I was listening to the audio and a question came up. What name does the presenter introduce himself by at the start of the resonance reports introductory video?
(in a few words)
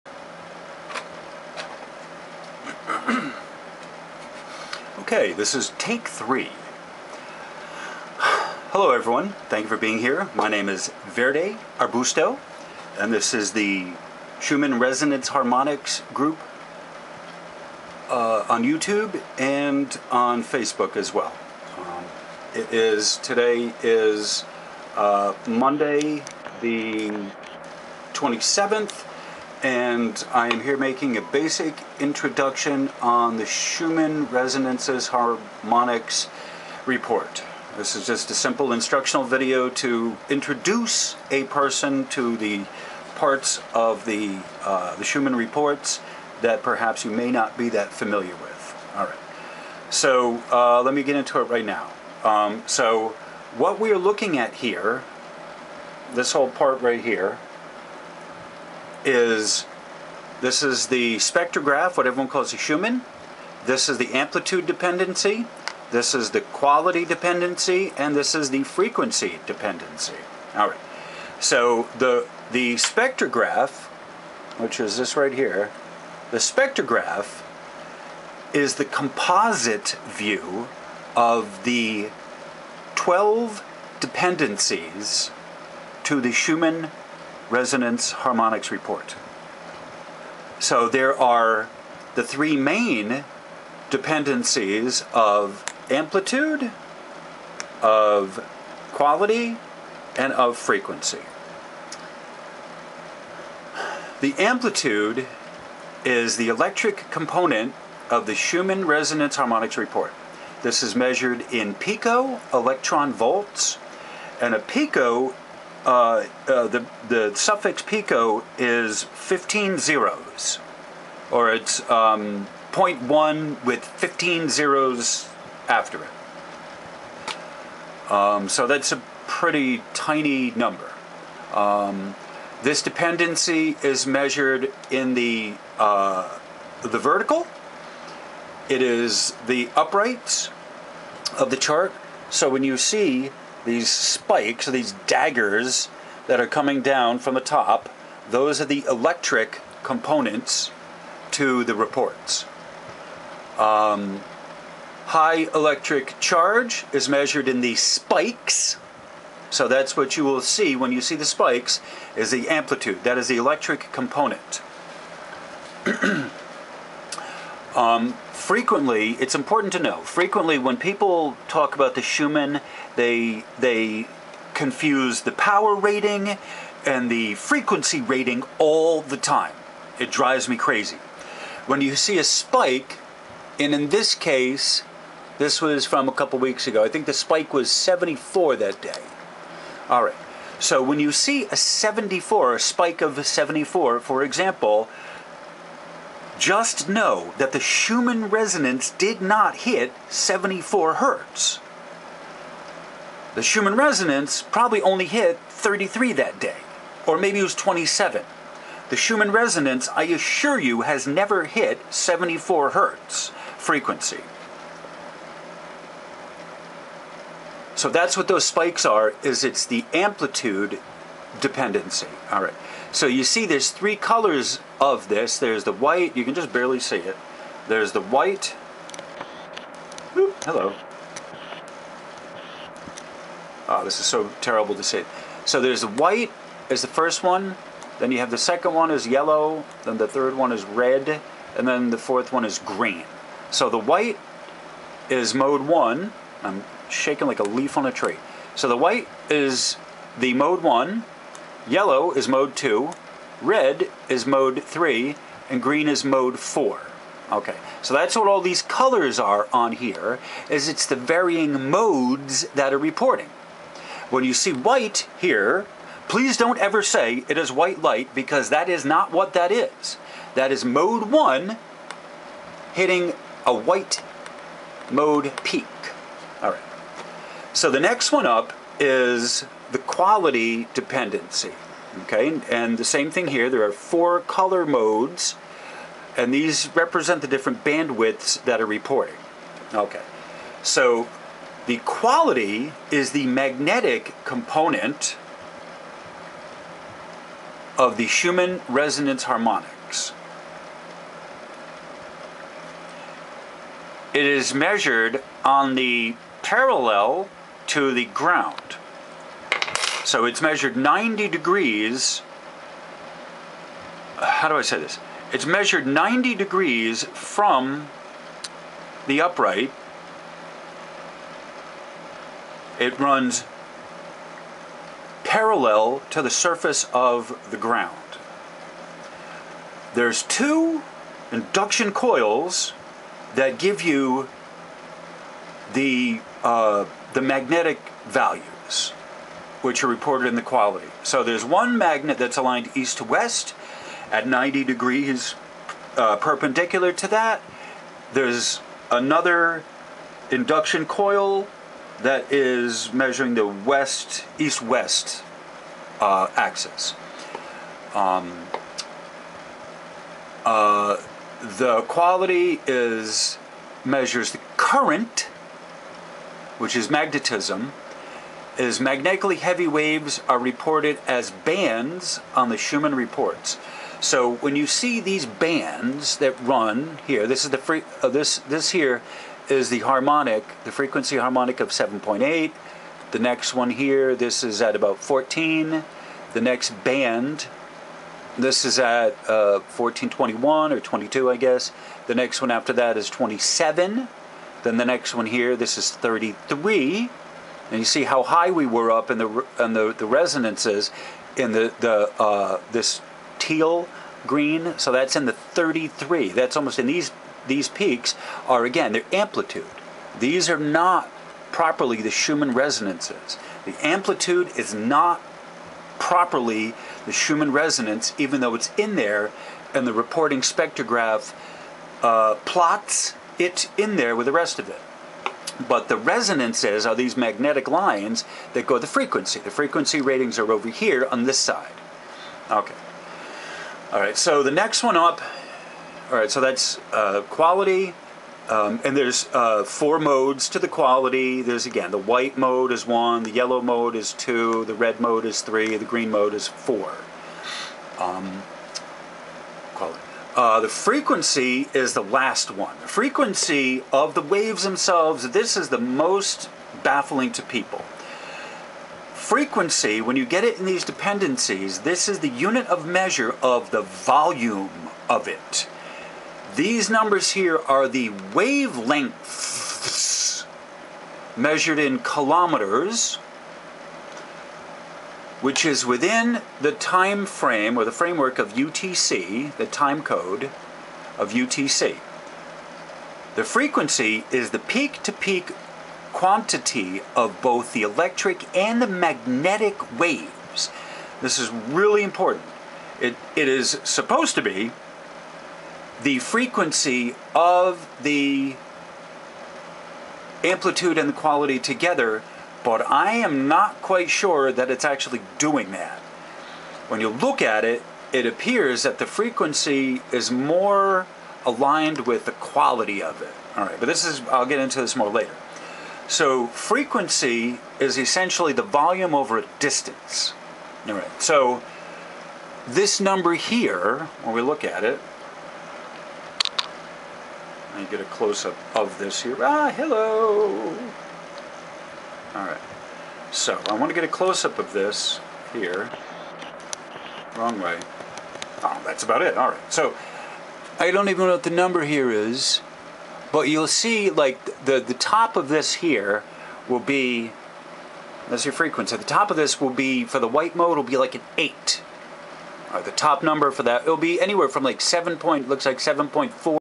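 Verde Arbusto.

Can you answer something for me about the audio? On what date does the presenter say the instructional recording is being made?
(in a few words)
Monday the 27th.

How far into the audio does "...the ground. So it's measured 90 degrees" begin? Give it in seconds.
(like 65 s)
307 s.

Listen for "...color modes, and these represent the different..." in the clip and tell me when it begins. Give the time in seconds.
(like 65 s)
284 s.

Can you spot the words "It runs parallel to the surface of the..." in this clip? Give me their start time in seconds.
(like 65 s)
322 s.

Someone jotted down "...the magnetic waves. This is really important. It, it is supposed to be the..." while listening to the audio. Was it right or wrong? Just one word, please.
right.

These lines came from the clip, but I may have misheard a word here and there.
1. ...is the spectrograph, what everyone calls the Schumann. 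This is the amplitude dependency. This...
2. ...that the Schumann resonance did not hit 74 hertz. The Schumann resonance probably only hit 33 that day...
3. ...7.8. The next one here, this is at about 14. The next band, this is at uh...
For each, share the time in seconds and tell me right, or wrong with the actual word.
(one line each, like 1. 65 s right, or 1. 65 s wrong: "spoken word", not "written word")
1. 60 s right
2. 197 s right
3. 381 s right.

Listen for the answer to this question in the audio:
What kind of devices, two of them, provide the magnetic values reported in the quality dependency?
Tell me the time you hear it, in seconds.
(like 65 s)
331 s.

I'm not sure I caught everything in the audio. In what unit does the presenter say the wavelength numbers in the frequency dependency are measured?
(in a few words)
kilometers.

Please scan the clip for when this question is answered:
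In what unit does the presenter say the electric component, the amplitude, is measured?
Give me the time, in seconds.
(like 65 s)
111 s.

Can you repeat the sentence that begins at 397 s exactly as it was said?
And you see how high we were up in the, in the, the resonances in the, the uh, this teal green.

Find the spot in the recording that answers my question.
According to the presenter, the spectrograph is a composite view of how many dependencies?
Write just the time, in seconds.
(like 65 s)
82 s.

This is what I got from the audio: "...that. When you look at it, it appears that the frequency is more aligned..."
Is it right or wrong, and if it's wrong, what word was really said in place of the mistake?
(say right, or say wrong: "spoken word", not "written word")
right.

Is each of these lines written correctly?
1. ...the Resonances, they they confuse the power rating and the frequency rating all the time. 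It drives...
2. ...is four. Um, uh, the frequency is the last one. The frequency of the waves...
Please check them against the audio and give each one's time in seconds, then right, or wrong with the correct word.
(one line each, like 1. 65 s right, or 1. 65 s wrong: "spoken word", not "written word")
1. 171 s wrong: "Schumann", not "Resonances"
2. 446 s right.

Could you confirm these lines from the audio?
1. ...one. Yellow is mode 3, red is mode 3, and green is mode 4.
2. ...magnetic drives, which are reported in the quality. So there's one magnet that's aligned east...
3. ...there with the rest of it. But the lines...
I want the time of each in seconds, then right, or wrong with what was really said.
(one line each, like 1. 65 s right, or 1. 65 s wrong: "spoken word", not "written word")
1. 250 s wrong: "2", not "3"
2. 337 s wrong: "values", not "drives"
3. 423 s wrong: "resonances", not "lines".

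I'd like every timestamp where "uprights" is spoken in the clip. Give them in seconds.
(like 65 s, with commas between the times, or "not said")
139 s, 319 s.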